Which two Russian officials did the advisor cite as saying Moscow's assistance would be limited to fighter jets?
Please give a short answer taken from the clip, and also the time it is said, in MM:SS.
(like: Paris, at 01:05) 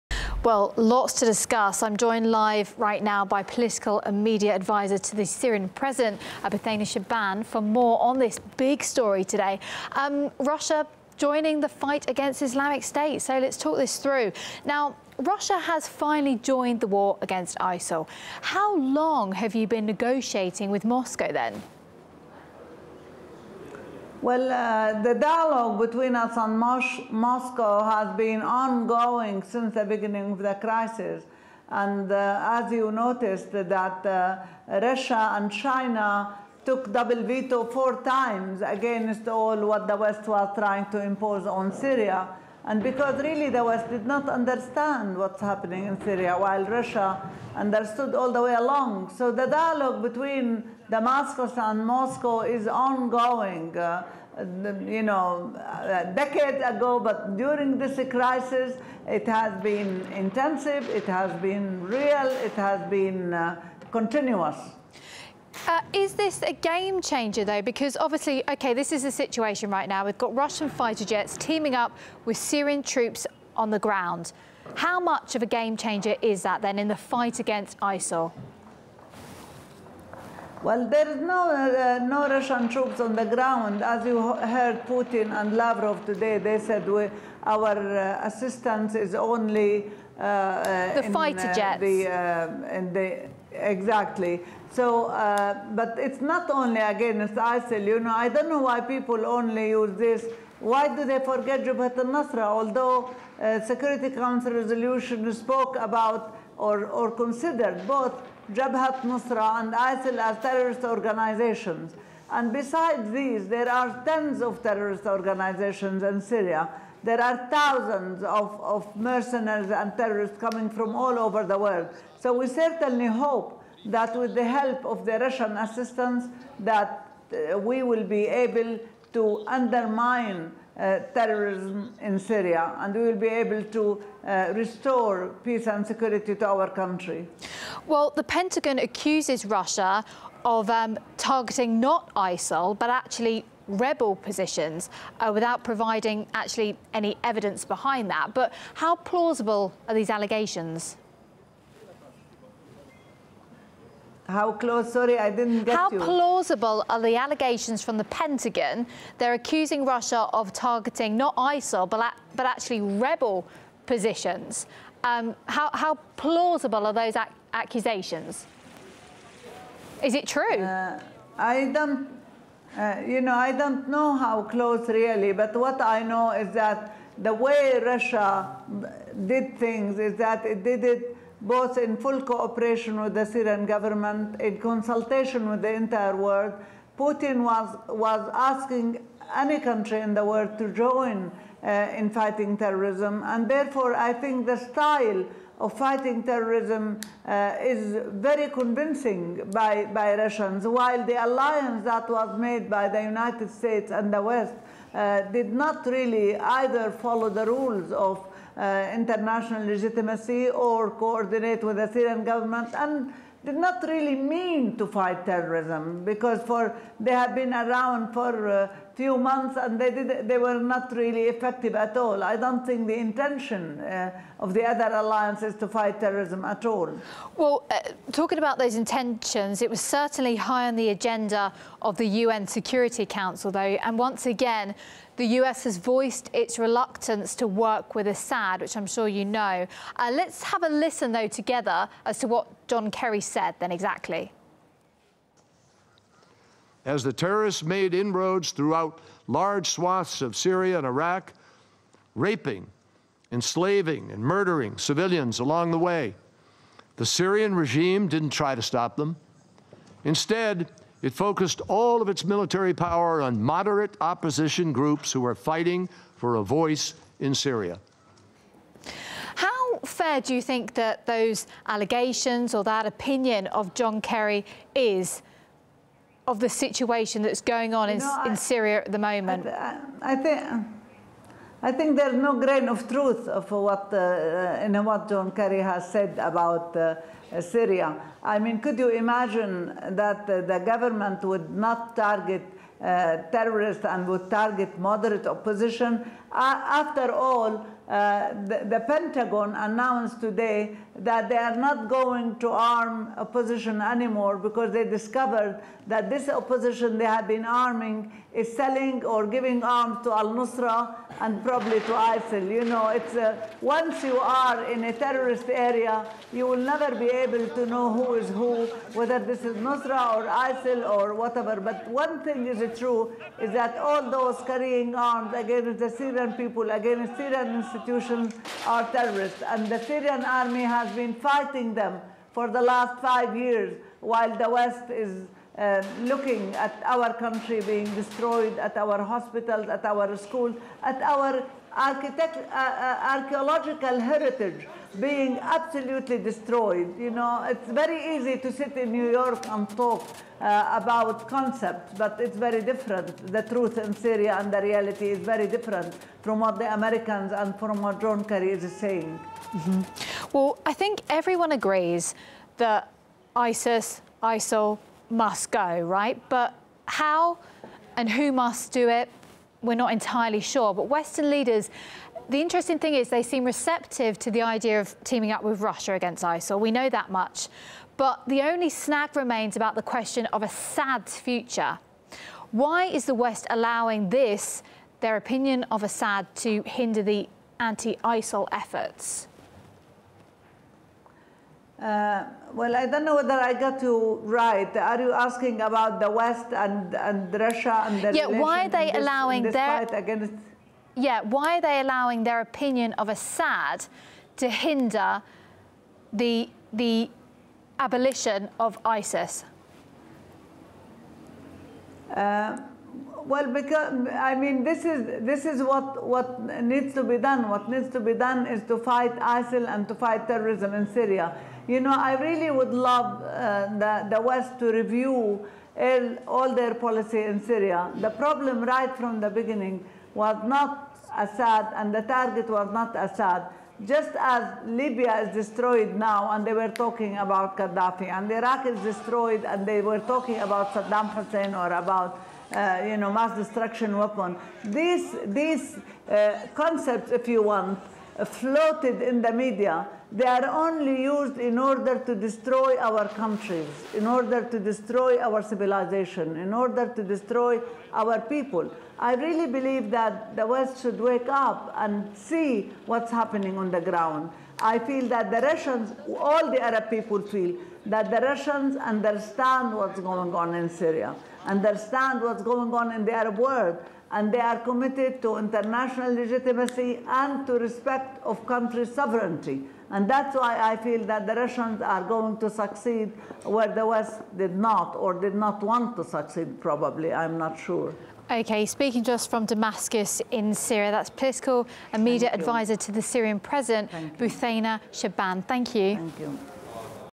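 Putin and Lavrov, at 01:24.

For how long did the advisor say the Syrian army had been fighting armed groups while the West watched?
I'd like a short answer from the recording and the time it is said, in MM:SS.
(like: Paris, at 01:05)
5 years, at 05:33.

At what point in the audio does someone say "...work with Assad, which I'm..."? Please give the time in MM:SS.
03:57.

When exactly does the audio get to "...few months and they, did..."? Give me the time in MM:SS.
03:38.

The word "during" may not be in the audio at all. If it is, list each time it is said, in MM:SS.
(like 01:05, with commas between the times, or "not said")
00:57.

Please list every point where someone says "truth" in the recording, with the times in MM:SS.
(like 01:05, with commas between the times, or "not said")
04:42, 05:53.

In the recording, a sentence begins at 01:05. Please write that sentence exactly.
Uh, is this a game changer, though?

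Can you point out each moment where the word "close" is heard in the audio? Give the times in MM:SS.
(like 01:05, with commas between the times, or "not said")
02:34, 02:54.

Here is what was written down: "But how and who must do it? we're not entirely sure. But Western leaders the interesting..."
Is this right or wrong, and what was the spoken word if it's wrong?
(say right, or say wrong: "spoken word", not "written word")
right.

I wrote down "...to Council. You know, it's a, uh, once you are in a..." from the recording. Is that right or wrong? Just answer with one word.
wrong.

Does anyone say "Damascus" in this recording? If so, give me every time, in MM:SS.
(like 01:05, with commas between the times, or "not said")
00:50, 08:09.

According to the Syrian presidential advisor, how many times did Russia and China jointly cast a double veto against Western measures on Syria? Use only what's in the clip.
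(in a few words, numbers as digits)
4.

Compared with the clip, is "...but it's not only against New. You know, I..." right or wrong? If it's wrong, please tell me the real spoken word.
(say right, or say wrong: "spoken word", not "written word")
wrong: "ISIL", not "New".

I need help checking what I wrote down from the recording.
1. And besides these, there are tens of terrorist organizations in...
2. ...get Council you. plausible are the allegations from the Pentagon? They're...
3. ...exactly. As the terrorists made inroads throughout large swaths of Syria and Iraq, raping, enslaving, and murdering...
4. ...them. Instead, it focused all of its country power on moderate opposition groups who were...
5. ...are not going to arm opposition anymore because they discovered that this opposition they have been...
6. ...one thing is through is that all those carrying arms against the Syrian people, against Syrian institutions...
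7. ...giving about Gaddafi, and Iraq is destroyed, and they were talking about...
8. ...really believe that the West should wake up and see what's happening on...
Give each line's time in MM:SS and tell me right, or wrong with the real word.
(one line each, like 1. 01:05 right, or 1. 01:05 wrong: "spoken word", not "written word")
1. 01:52 right
2. 02:35 wrong: "How", not "Council"
3. 04:03 right
4. 04:18 wrong: "military", not "country"
5. 05:01 right
6. 05:21 right
7. 07:16 wrong: "talking", not "giving"
8. 07:39 right.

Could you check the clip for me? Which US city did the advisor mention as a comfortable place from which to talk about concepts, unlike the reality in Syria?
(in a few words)
New York.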